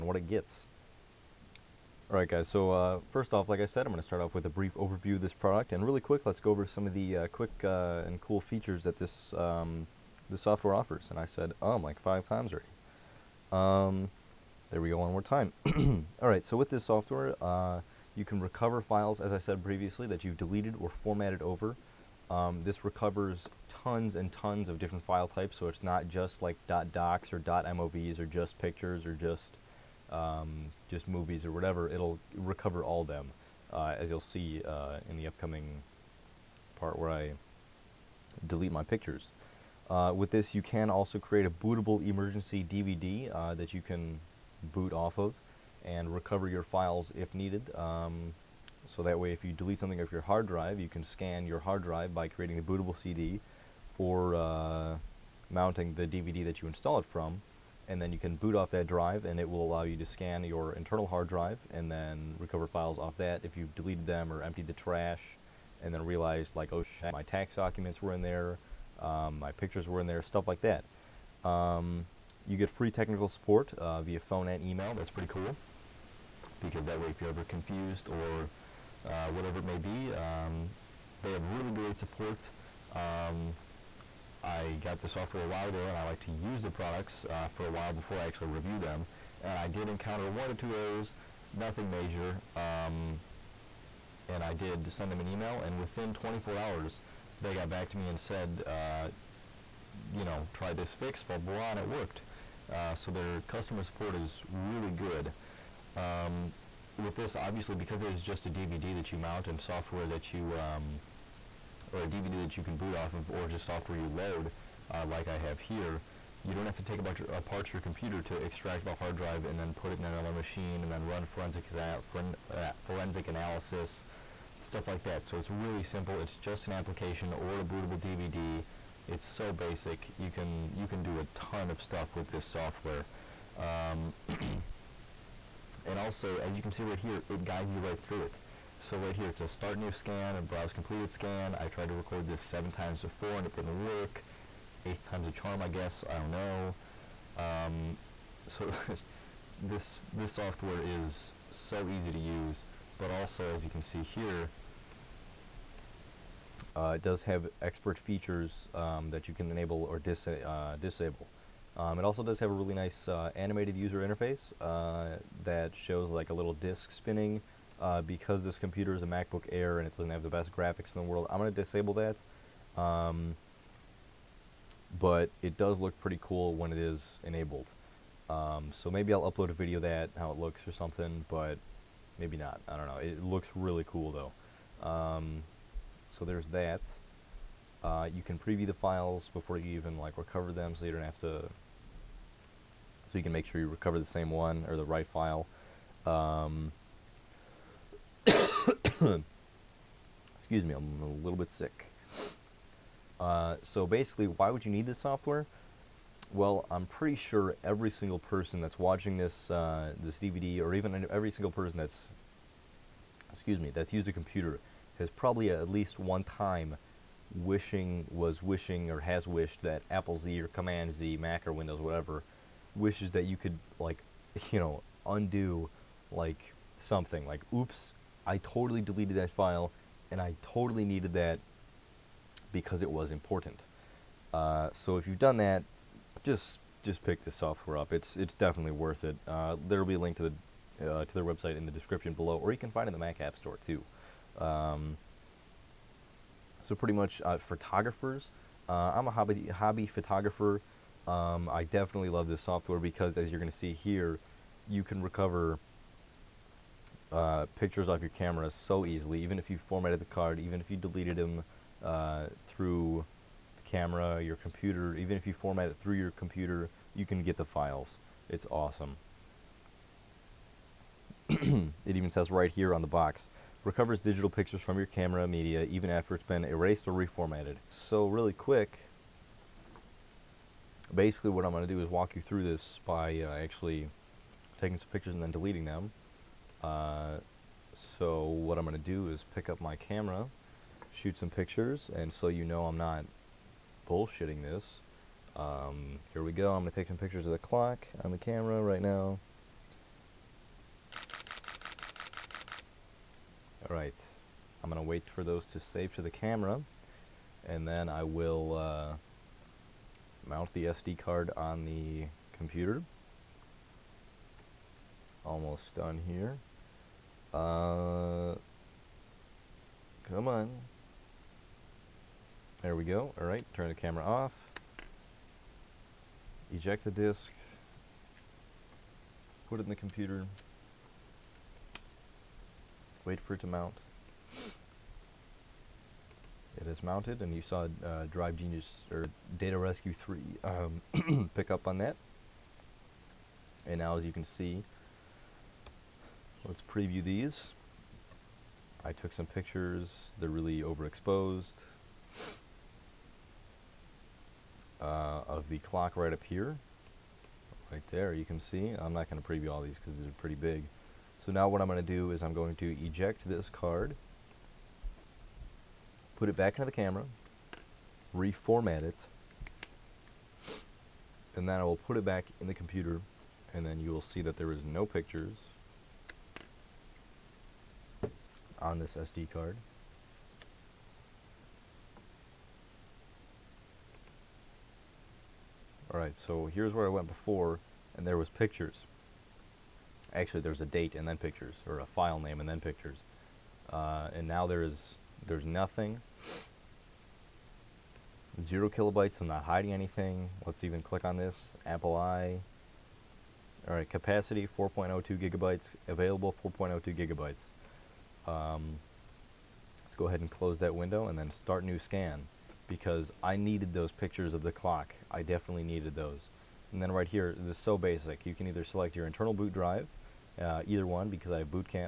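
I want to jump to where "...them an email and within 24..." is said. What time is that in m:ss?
1:35.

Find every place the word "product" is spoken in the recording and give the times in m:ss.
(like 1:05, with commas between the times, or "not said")
0:05, 1:26.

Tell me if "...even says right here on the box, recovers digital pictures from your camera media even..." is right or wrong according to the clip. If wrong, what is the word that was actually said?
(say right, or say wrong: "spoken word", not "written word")
right.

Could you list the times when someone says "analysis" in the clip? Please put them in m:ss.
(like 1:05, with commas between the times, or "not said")
2:03.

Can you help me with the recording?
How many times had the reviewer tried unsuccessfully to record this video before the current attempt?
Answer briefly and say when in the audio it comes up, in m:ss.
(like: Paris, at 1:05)
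7, at 2:22.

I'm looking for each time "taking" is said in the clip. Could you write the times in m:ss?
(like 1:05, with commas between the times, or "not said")
4:44.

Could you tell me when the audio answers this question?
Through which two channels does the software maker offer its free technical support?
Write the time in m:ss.
1:14.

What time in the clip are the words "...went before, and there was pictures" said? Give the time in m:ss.
6:26.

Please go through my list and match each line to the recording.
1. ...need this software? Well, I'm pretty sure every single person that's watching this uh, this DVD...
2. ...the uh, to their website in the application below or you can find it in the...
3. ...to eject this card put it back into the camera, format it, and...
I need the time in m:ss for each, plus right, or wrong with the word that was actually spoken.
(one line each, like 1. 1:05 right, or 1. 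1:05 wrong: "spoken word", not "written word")
1. 3:24 right
2. 4:00 wrong: "description", not "application"
3. 6:02 wrong: "reformat", not "format".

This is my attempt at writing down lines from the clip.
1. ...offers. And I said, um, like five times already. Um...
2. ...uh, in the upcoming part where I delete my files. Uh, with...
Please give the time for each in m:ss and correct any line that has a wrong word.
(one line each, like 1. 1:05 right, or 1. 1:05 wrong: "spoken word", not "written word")
1. 0:10 right
2. 0:34 wrong: "pictures", not "files".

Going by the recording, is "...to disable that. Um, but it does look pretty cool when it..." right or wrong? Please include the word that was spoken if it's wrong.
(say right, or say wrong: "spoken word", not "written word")
right.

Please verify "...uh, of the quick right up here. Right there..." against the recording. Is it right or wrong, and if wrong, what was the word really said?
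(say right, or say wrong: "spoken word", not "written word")
wrong: "clock", not "quick".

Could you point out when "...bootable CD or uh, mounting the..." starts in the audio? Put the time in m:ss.
0:52.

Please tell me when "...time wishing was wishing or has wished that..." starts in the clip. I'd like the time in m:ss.
3:36.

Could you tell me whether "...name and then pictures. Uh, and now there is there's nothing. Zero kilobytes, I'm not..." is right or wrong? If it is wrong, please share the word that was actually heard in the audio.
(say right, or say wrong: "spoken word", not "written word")
right.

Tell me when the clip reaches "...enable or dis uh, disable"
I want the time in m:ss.
2:39.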